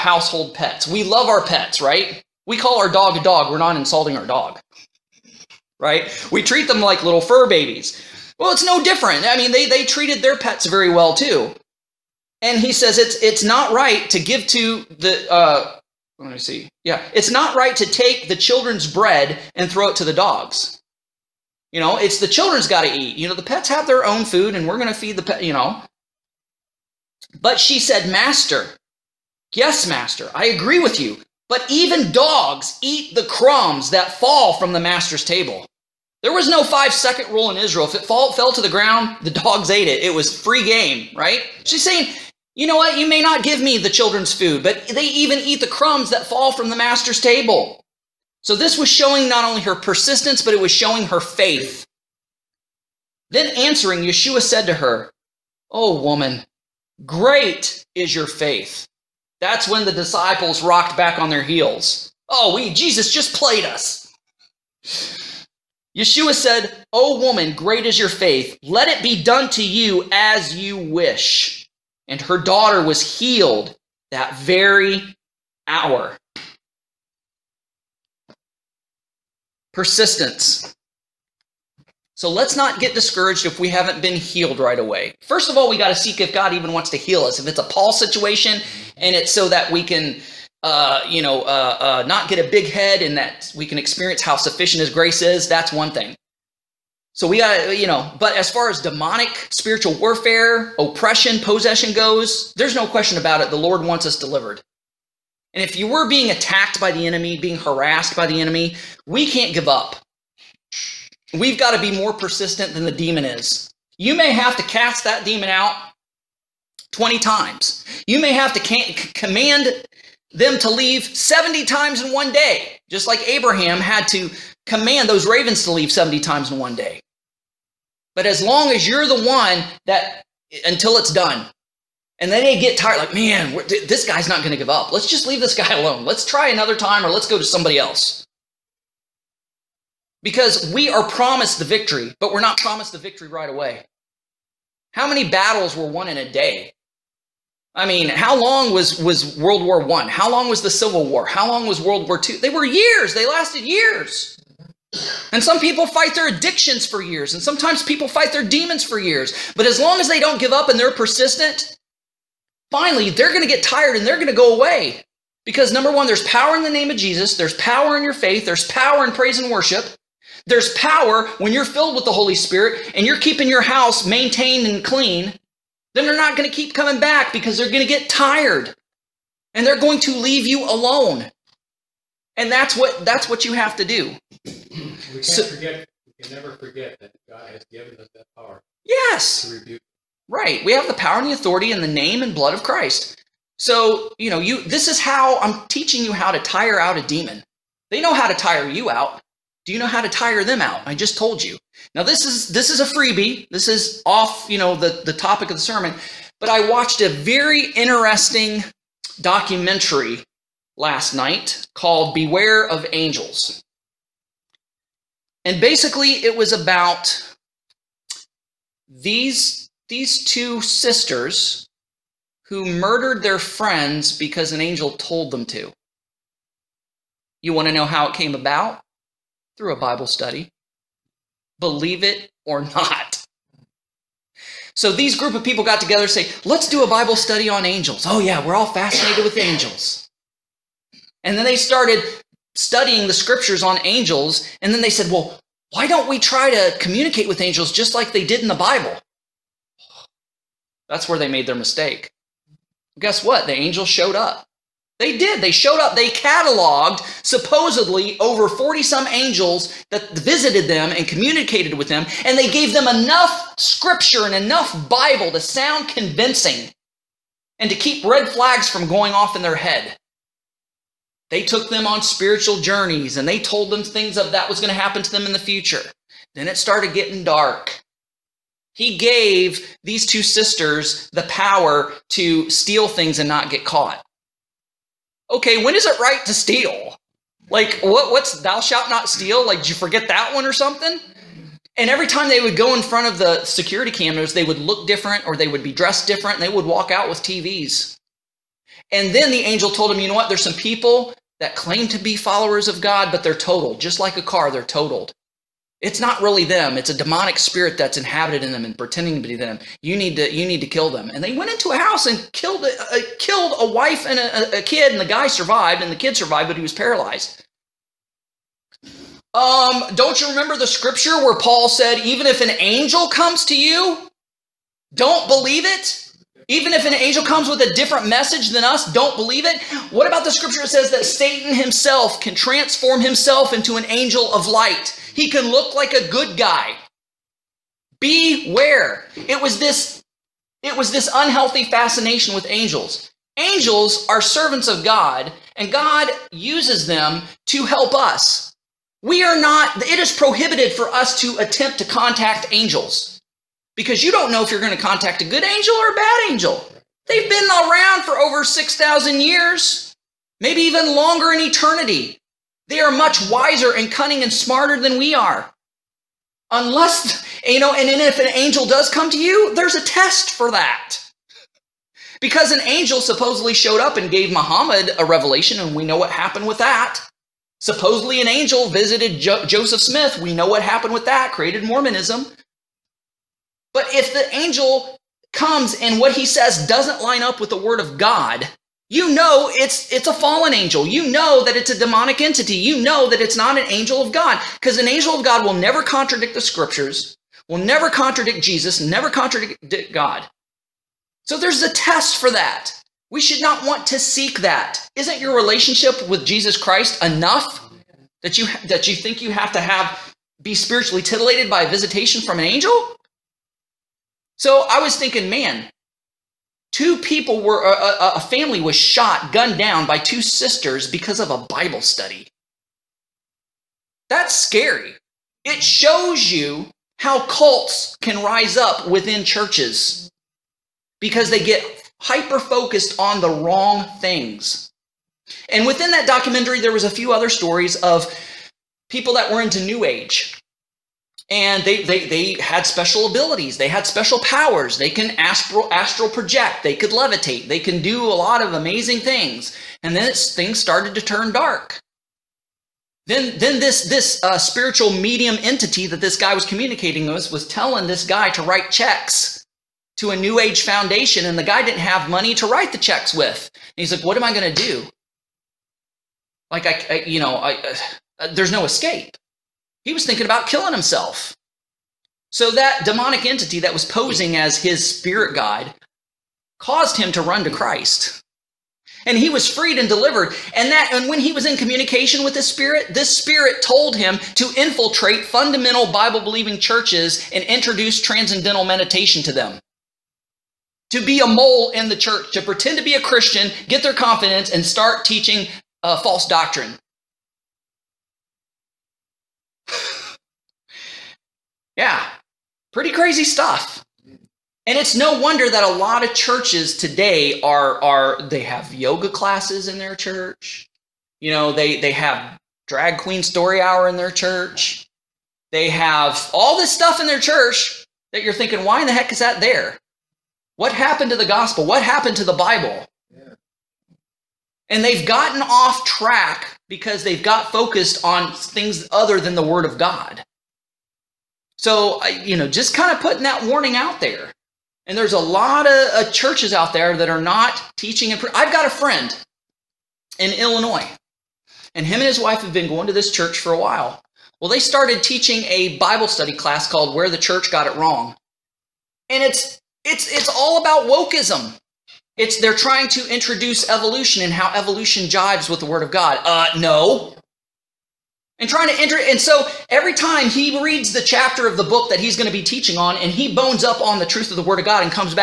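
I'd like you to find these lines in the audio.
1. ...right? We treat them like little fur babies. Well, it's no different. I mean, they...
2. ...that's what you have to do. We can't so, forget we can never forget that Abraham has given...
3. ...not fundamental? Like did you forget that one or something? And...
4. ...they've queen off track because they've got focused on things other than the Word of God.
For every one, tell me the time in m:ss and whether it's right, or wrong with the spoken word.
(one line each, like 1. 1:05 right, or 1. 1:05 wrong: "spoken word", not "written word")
1. 0:05 right
2. 3:03 wrong: "God", not "Abraham"
3. 4:48 wrong: "steal", not "fundamental"
4. 8:44 wrong: "gotten", not "queen".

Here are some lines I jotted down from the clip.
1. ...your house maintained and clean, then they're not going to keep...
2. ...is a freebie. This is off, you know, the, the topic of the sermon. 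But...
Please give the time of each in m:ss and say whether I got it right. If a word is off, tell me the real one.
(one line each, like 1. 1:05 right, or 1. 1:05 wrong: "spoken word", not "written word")
1. 2:53 right
2. 3:22 right.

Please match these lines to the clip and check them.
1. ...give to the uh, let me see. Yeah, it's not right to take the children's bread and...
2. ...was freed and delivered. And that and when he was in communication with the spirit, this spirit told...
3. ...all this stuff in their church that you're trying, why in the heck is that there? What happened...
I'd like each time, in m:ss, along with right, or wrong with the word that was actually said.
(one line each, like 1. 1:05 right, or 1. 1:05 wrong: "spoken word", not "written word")
1. 0:14 right
2. 7:59 right
3. 8:36 wrong: "thinking", not "trying".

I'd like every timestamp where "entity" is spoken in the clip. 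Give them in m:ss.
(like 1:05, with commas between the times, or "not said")
6:32, 7:35, 7:53.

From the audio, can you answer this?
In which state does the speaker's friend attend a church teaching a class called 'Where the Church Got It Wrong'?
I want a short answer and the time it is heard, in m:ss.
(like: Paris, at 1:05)
Illinois, at 9:00.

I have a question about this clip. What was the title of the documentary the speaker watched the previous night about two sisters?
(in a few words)
Beware of Angels.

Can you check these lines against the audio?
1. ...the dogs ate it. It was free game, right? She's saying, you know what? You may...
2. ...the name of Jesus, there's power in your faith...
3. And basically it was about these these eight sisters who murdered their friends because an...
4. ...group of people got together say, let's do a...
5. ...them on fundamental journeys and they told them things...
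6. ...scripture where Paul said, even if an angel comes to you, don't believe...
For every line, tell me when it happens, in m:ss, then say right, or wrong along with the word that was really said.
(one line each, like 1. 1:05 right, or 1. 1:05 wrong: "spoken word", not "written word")
1. 0:39 right
2. 2:46 right
3. 3:35 wrong: "two", not "eight"
4. 3:55 right
5. 4:31 wrong: "spiritual", not "fundamental"
6. 5:20 right.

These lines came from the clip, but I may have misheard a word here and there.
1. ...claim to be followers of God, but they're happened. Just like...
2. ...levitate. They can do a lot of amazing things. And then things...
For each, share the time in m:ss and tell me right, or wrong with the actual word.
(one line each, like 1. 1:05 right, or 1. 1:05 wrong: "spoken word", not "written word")
1. 5:01 wrong: "totaled", not "happened"
2. 7:26 right.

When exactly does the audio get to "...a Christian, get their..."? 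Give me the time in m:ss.
8:12.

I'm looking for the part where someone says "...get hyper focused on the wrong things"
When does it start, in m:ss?
7:11.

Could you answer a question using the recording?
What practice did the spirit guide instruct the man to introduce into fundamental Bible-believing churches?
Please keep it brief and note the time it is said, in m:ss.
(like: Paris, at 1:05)
transcendental meditation, at 8:08.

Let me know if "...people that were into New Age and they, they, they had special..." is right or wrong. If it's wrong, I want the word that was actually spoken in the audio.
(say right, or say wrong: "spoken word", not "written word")
right.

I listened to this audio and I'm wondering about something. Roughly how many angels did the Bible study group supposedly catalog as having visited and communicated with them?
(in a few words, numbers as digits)
over 40.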